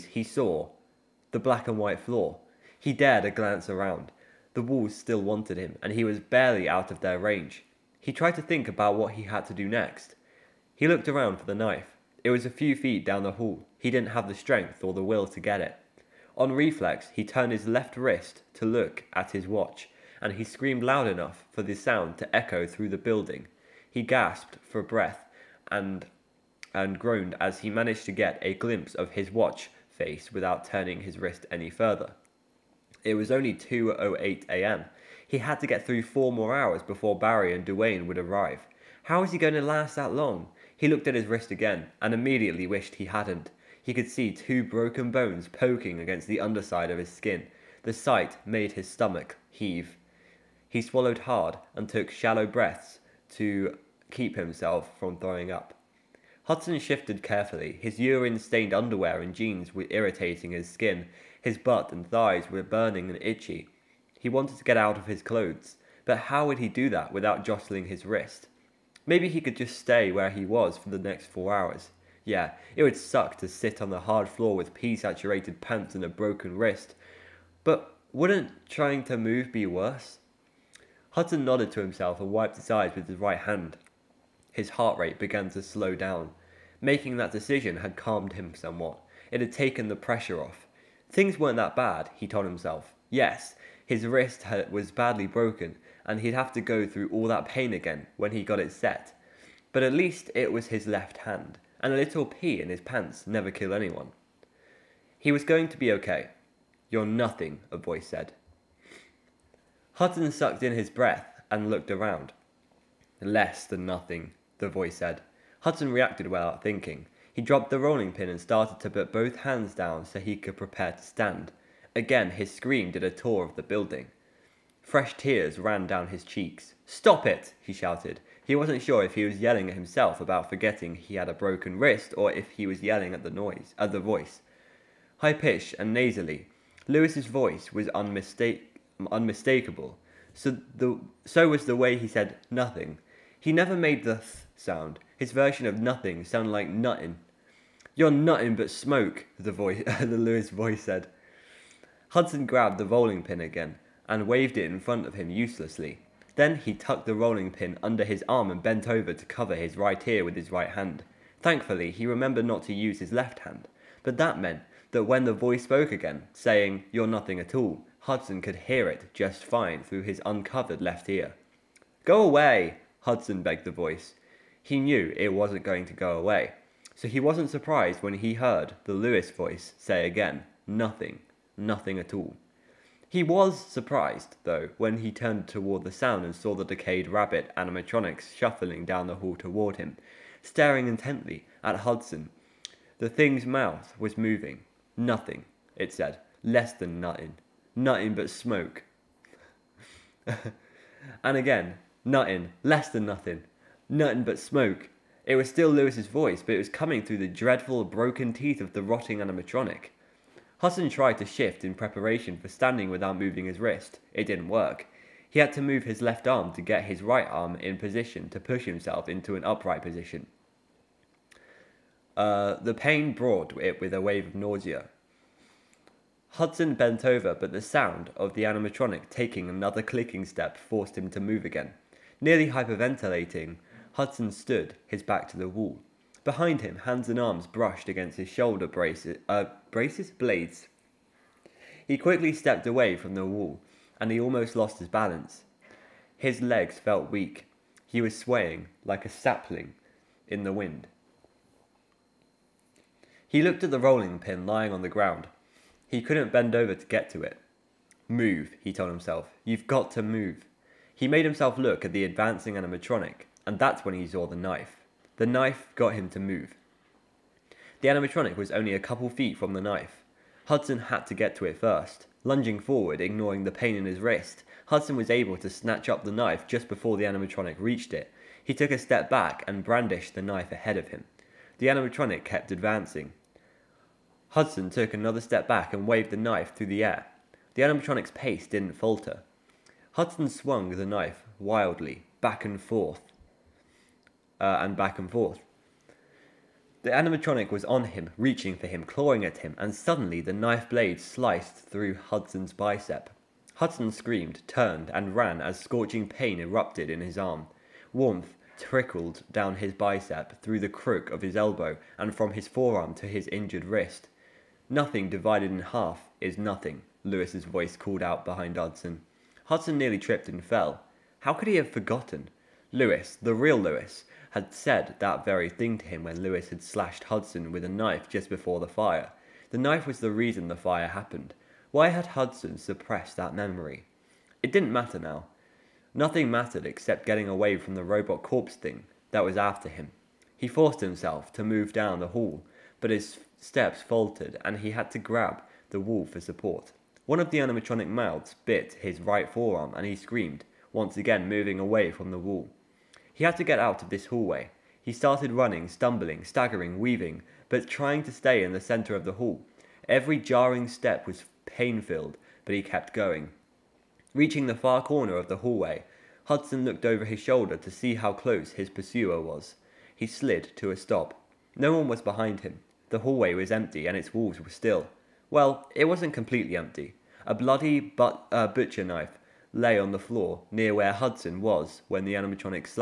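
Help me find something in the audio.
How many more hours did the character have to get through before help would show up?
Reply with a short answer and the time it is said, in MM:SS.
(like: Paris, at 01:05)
4, at 00:36.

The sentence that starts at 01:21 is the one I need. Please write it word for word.
Hudson nodded to himself and wiped his eyes with his right hand.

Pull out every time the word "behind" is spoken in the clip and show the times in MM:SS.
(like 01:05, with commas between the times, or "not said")
03:56, 05:18, 06:11.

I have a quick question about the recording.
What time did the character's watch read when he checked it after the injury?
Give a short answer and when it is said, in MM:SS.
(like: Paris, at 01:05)
2:08 a.m., at 00:33.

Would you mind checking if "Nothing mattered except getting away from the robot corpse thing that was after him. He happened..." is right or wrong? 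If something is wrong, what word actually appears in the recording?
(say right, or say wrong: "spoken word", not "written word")
wrong: "forced", not "happened".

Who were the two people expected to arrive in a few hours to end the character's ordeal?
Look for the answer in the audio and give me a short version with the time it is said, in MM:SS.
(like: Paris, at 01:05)
Barry and Duane, at 00:37.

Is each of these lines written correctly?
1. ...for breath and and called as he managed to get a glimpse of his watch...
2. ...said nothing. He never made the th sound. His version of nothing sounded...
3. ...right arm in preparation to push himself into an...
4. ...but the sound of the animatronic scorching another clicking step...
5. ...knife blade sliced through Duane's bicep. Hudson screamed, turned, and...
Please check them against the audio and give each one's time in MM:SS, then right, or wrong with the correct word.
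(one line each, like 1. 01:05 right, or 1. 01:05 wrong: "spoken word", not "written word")
1. 00:24 wrong: "groaned", not "called"
2. 02:22 right
3. 03:37 wrong: "position", not "preparation"
4. 03:47 wrong: "taking", not "scorching"
5. 05:00 wrong: "Hudson", not "Duane".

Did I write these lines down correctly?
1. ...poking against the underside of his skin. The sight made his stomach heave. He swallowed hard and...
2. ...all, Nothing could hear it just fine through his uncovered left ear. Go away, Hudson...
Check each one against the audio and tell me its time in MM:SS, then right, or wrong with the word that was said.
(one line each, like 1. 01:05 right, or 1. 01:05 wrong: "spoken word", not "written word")
1. 00:45 right
2. 02:47 wrong: "Hudson", not "Nothing".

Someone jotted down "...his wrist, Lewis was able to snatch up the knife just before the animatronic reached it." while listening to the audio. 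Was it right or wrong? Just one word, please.
wrong.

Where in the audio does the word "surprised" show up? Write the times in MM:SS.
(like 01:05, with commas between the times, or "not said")
02:57, 03:03.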